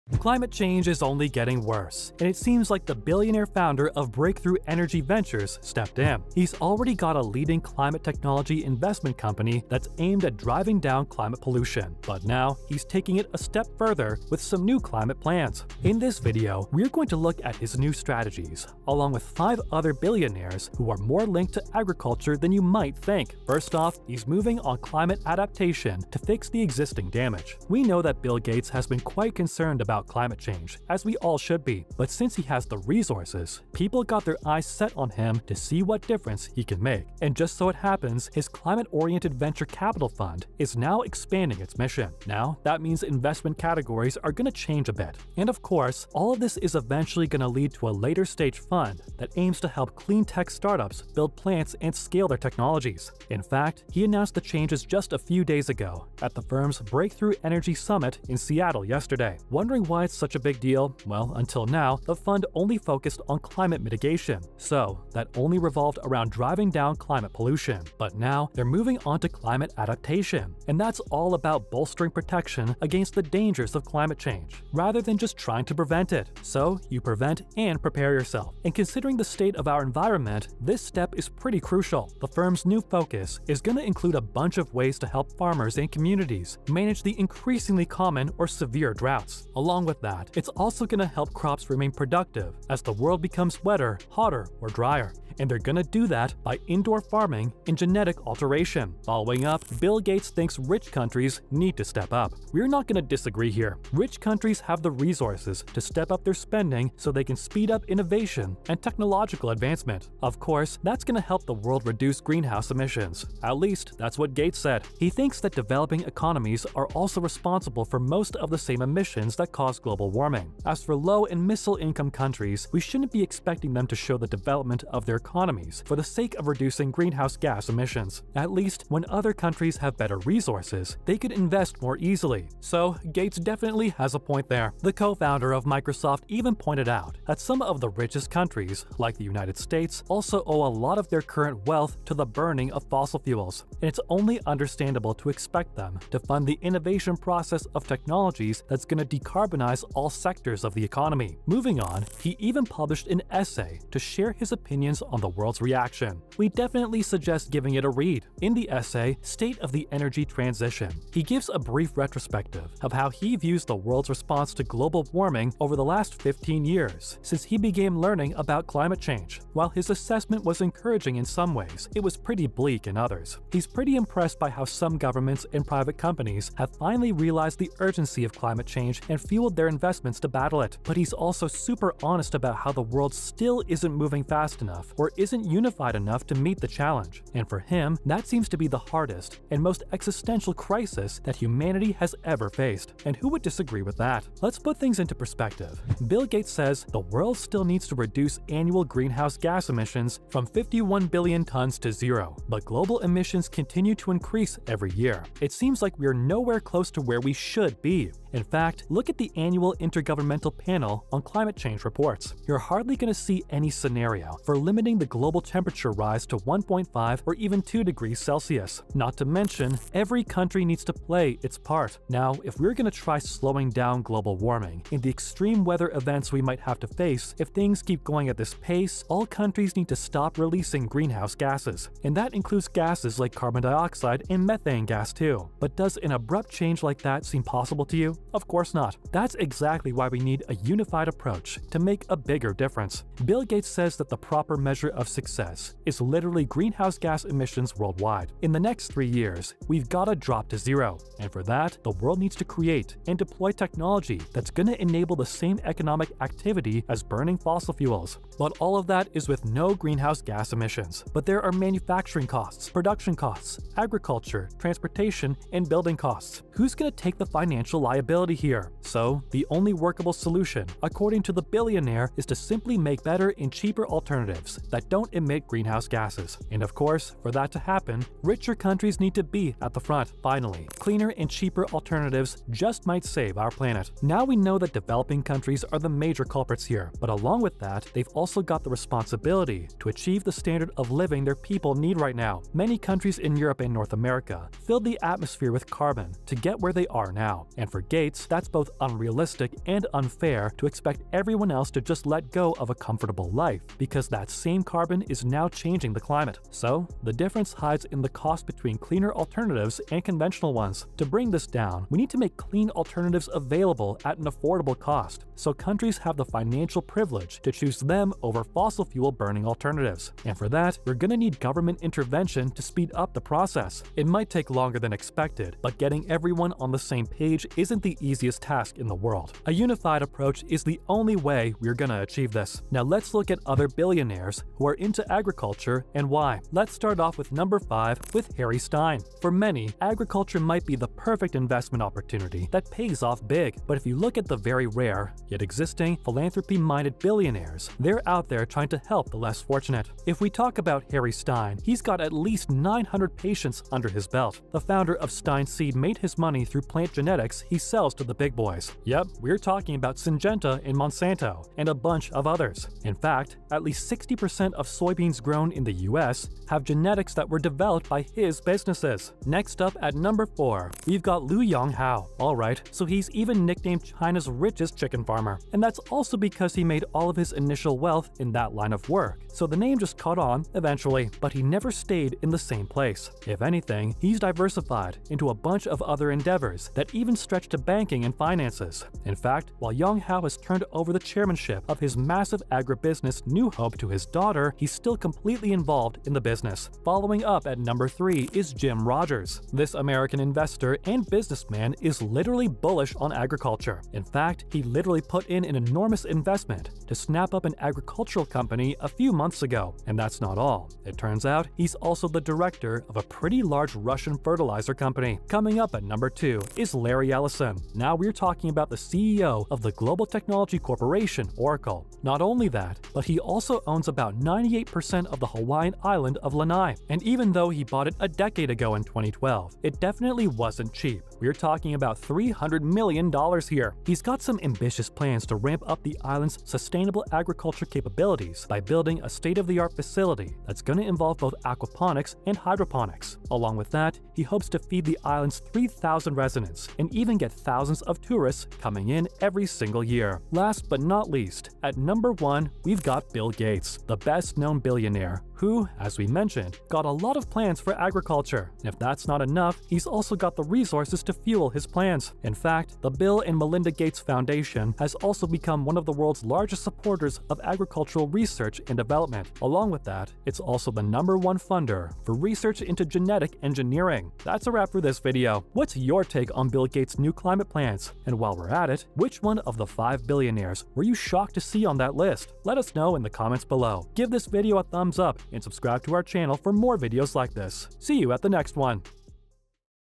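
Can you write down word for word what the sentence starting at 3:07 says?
And for him, that seems to be the hardest and most existential crisis that humanity has ever faced.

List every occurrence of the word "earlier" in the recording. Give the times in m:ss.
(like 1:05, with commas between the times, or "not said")
not said.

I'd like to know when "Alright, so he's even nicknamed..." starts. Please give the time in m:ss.
6:12.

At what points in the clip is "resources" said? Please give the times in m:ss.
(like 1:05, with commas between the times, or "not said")
0:32, 1:44, 2:10, 7:40.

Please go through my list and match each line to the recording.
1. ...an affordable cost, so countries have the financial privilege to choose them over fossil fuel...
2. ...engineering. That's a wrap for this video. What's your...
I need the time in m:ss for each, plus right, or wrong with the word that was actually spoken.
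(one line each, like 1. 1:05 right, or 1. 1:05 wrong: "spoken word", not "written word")
1. 5:14 right
2. 7:53 right.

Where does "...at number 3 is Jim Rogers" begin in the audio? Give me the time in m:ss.
6:37.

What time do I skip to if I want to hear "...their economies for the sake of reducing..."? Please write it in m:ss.
2:05.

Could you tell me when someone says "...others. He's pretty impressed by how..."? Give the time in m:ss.
2:52.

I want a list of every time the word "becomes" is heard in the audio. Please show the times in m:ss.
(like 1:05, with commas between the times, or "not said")
1:33, 7:45.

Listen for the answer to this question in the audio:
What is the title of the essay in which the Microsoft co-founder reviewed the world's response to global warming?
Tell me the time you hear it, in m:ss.
2:39.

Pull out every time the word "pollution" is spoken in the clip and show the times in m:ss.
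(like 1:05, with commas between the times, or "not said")
0:11, 1:07.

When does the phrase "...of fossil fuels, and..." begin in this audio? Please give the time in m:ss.
2:22.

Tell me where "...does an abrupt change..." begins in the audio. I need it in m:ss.
3:55.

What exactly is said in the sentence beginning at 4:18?
But all of that is with no greenhouse gas emissions.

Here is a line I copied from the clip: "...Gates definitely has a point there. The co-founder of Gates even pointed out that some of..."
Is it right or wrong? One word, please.
wrong.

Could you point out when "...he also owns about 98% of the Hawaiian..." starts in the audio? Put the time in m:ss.
7:03.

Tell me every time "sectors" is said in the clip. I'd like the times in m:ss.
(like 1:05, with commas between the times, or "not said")
2:30.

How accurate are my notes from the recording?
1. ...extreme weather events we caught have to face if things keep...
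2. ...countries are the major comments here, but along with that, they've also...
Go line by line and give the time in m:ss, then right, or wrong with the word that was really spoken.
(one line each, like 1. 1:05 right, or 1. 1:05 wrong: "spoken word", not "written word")
1. 3:45 wrong: "might", not "caught"
2. 4:45 wrong: "culprits", not "comments".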